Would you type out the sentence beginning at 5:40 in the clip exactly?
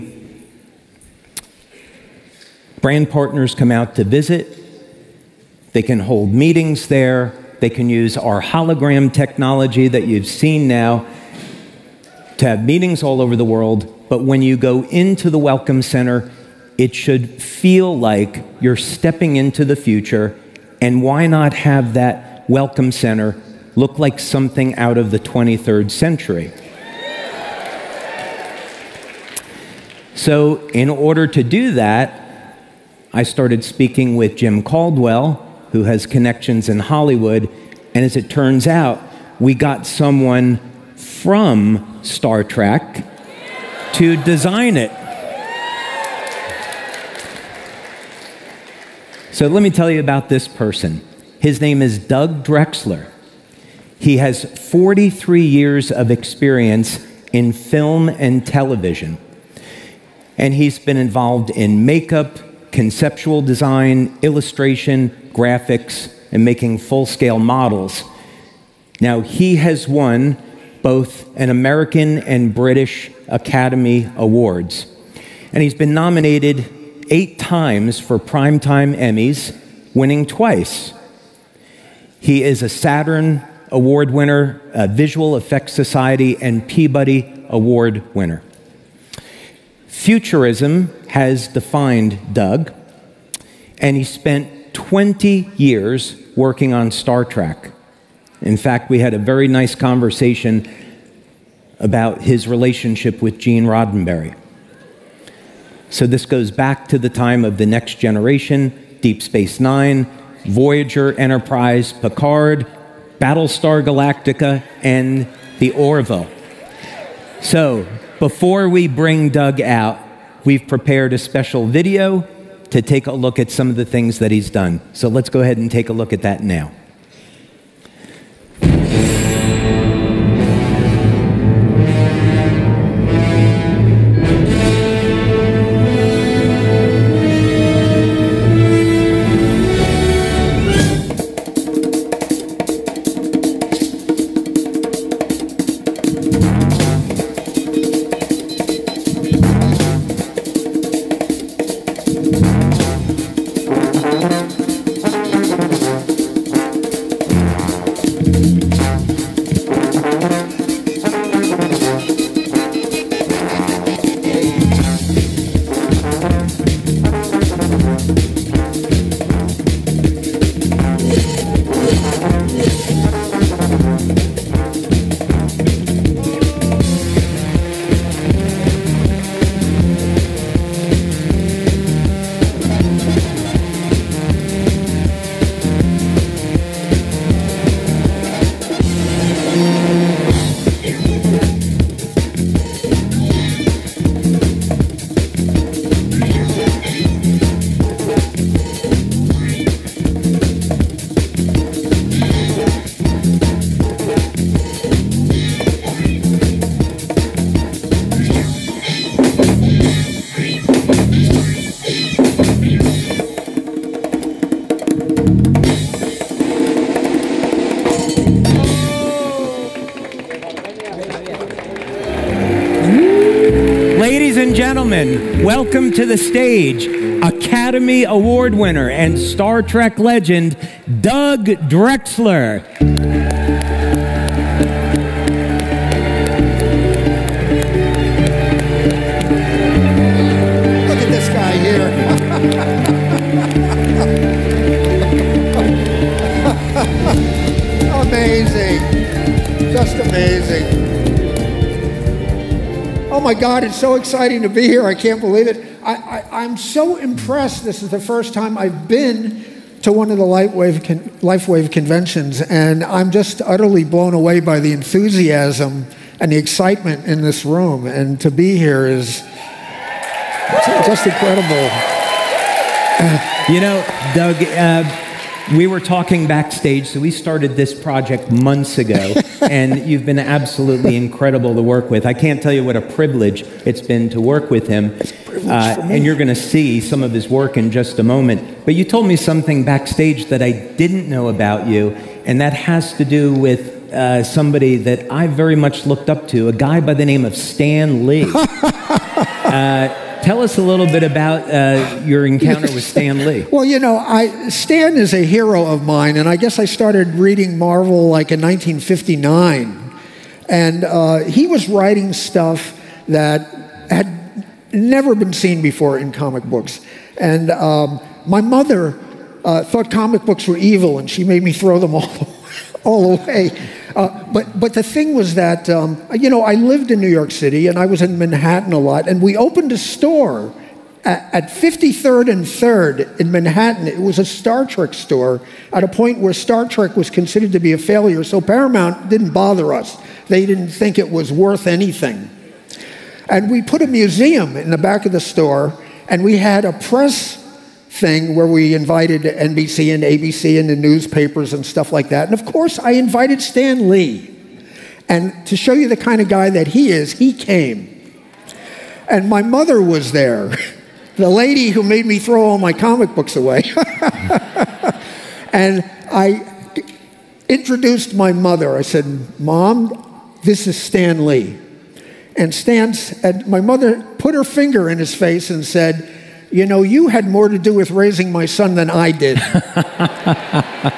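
They didn't think it was worth anything.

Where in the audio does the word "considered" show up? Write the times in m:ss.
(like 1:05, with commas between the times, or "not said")
5:37.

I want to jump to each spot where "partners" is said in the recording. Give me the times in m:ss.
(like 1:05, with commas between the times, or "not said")
0:03.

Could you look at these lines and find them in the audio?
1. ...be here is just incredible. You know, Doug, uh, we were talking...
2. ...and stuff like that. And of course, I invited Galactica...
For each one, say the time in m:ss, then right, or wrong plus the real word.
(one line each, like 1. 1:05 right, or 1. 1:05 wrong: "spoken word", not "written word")
1. 4:28 right
2. 5:51 wrong: "Stan", not "Galactica".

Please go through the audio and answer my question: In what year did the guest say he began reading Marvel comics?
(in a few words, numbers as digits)
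1959.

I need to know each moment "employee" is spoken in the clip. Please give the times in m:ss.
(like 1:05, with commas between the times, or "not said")
not said.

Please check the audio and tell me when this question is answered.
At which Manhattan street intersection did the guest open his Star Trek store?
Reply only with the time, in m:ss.
5:31.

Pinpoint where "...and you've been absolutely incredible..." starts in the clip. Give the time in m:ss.
4:39.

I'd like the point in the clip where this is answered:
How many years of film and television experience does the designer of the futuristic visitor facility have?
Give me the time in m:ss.
0:54.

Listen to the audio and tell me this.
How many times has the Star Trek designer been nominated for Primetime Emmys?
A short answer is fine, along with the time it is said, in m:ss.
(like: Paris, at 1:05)
eight, at 1:17.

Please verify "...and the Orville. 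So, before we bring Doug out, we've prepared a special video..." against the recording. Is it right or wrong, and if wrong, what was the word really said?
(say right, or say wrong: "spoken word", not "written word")
right.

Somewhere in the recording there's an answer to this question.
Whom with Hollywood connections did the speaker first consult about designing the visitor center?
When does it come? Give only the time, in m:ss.
0:34.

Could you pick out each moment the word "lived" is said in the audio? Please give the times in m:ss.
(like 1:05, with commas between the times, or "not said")
5:26.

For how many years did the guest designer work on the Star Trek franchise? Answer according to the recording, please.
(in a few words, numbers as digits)
20.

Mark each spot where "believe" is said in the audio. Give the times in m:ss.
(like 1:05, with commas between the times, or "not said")
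4:15.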